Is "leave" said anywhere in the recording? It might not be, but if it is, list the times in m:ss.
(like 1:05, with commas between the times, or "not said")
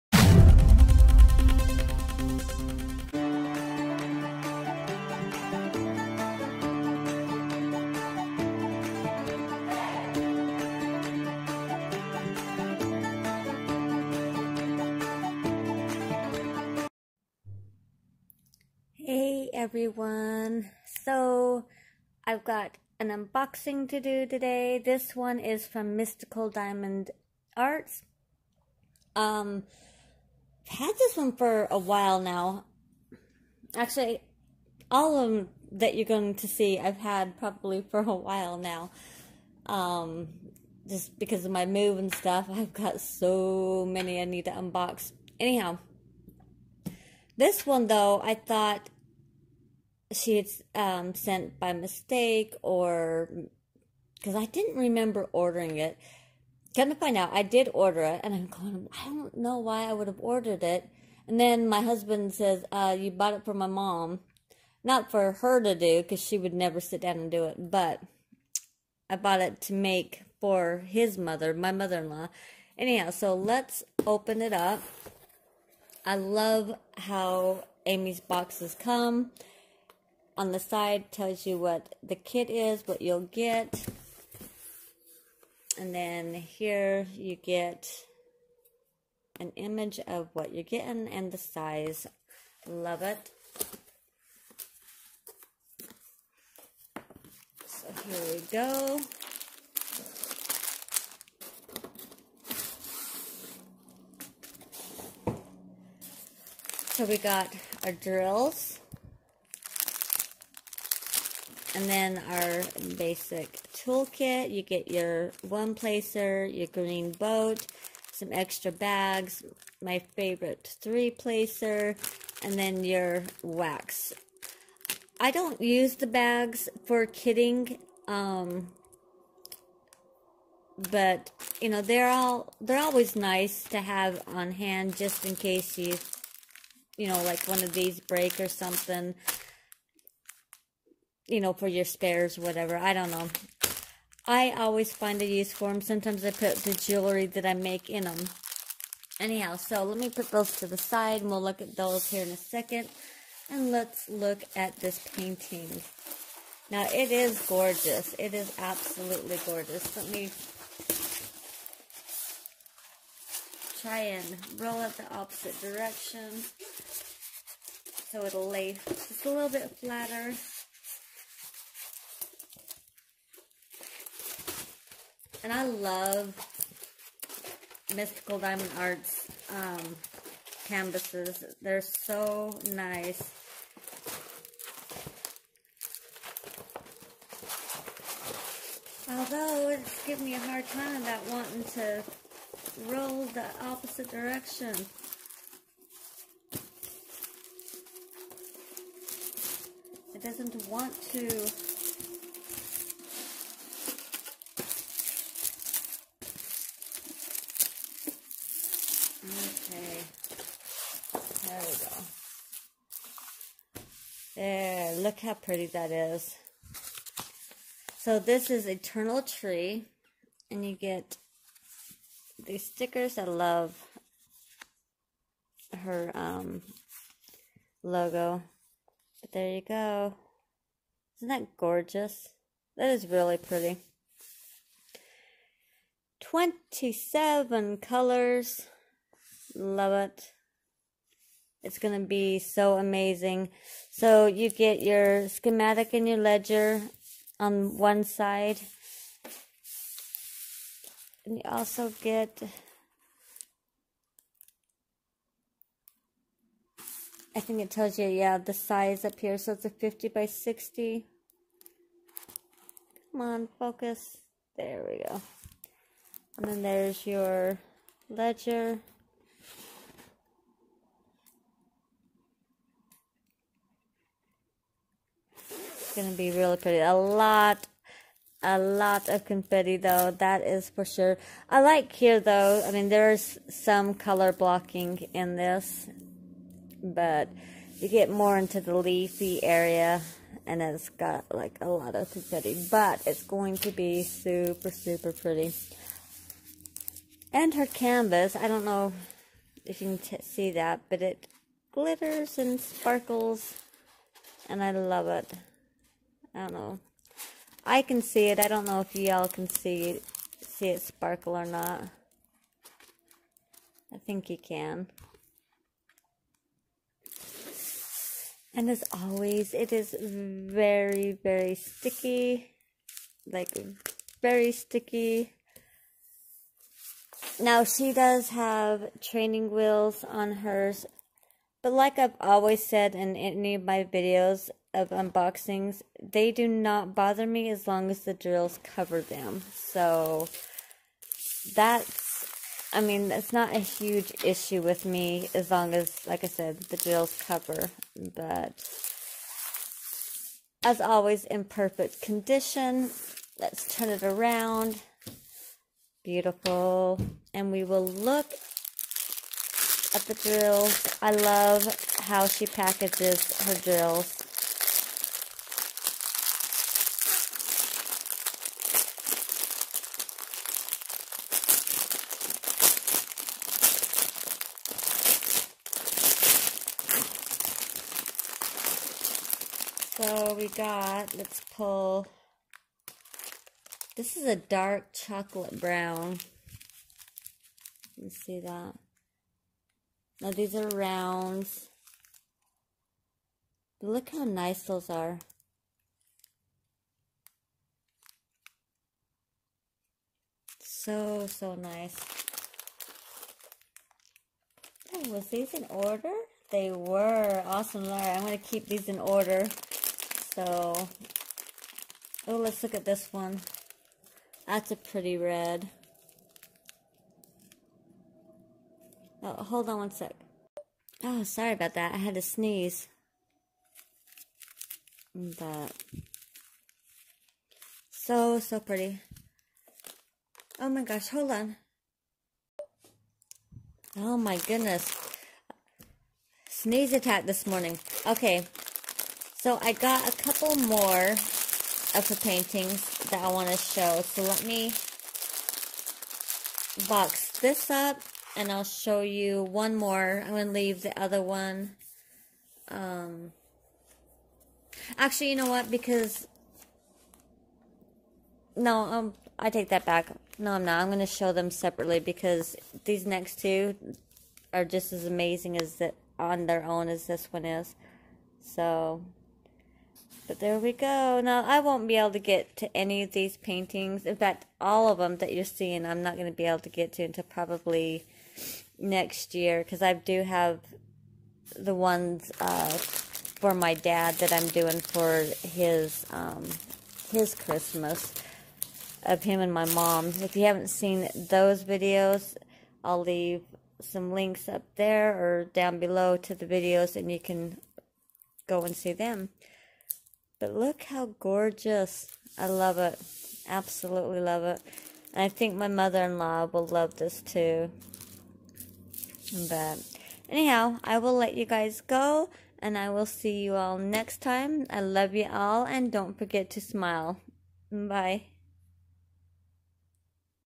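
7:30, 8:13.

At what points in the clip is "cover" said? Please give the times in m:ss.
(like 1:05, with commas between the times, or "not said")
5:38, 5:47.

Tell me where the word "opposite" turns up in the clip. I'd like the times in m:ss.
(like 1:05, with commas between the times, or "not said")
2:45, 3:13.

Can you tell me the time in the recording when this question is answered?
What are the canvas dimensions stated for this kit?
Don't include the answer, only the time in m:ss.
4:19.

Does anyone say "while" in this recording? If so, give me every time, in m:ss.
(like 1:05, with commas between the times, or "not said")
0:31, 0:38.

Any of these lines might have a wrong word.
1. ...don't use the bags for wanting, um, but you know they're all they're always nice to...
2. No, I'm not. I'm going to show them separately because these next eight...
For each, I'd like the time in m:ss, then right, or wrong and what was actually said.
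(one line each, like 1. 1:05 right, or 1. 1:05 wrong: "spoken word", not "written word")
1. 2:05 wrong: "kitting", not "wanting"
2. 7:40 wrong: "two", not "eight".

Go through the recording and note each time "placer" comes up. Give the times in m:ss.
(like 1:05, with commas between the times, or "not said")
1:55, 2:01.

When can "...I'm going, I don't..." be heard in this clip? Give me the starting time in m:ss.
0:58.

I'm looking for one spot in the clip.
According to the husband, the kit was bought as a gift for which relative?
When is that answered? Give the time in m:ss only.
1:11.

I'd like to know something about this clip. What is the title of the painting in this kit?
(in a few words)
Eternal Tree.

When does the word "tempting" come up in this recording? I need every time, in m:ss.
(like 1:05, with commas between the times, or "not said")
not said.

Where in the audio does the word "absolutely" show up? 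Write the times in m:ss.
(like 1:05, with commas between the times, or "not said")
2:38, 8:23.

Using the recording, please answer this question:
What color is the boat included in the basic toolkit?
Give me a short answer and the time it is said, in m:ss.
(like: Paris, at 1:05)
green, at 1:56.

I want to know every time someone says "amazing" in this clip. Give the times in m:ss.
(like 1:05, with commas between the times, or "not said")
4:02, 7:45.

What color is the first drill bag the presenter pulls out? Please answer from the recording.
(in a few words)
dark chocolate brown.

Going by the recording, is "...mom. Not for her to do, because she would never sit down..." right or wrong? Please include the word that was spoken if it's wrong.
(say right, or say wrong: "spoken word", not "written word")
right.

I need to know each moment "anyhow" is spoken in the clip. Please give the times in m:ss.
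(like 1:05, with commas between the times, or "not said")
0:45, 1:12, 2:29, 8:30.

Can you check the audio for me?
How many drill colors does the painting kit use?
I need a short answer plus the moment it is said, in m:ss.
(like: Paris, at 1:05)
27, at 3:56.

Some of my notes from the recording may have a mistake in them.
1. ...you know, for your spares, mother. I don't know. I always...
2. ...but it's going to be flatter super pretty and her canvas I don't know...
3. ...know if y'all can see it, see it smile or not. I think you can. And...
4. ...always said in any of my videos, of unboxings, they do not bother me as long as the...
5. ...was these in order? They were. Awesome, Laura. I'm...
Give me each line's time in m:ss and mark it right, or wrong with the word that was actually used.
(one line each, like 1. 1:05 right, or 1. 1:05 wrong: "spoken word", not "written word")
1. 2:21 wrong: "whatever", not "mother"
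2. 4:52 wrong: "super", not "flatter"
3. 5:08 wrong: "sparkle", not "smile"
4. 5:32 right
5. 6:45 right.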